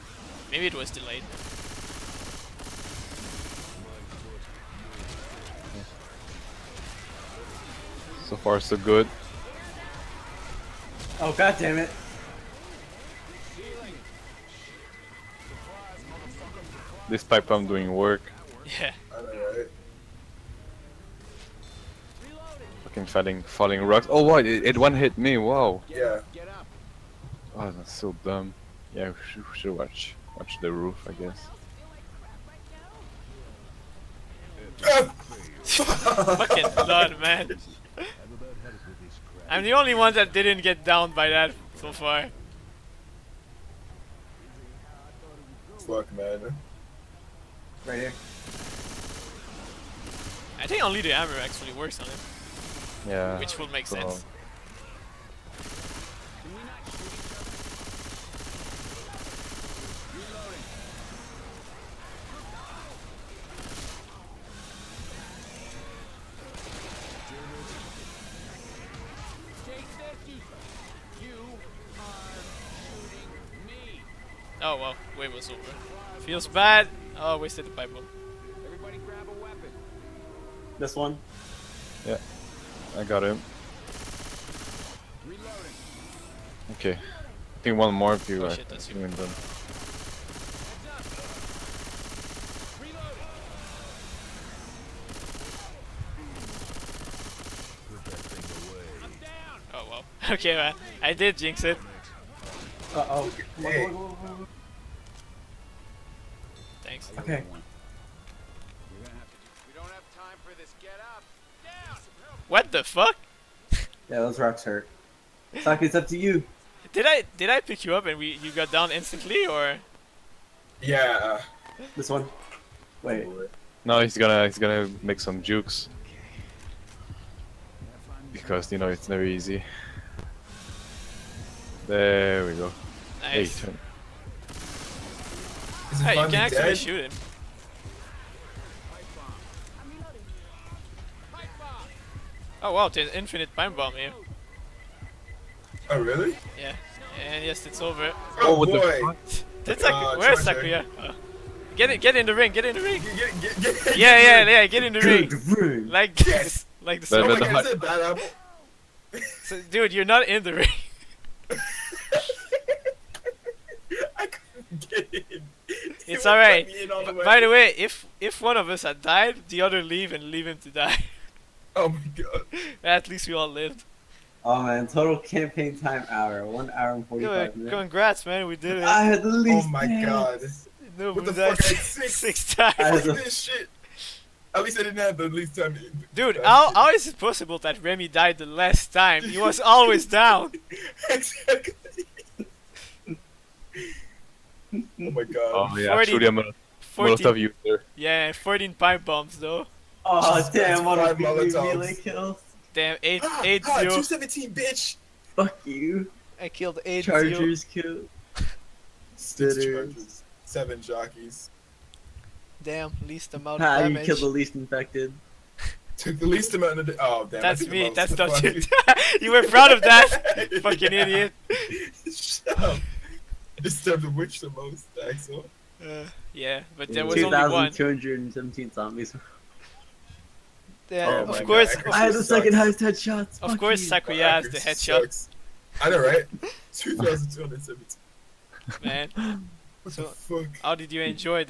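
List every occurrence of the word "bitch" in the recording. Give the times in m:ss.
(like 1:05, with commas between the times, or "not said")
3:24.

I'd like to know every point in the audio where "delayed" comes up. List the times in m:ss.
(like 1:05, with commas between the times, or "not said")
0:00.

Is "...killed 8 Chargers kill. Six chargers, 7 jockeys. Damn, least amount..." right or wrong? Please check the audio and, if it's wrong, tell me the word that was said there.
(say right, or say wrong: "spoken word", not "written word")
right.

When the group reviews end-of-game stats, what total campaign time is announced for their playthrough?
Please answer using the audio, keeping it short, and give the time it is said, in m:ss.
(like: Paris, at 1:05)
1 hour 45 minutes, at 2:56.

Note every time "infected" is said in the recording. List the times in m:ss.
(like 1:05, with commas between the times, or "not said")
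3:34.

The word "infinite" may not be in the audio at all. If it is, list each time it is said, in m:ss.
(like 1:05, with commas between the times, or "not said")
2:23.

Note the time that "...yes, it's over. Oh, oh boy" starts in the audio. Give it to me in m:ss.
2:27.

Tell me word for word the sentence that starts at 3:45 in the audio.
Uh, yeah, but there was only one.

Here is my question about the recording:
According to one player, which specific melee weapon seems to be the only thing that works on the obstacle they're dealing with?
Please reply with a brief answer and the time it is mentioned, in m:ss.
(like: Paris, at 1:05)
The hammer, at 0:51.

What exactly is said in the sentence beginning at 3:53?
Of course, Sakuya has the headshots.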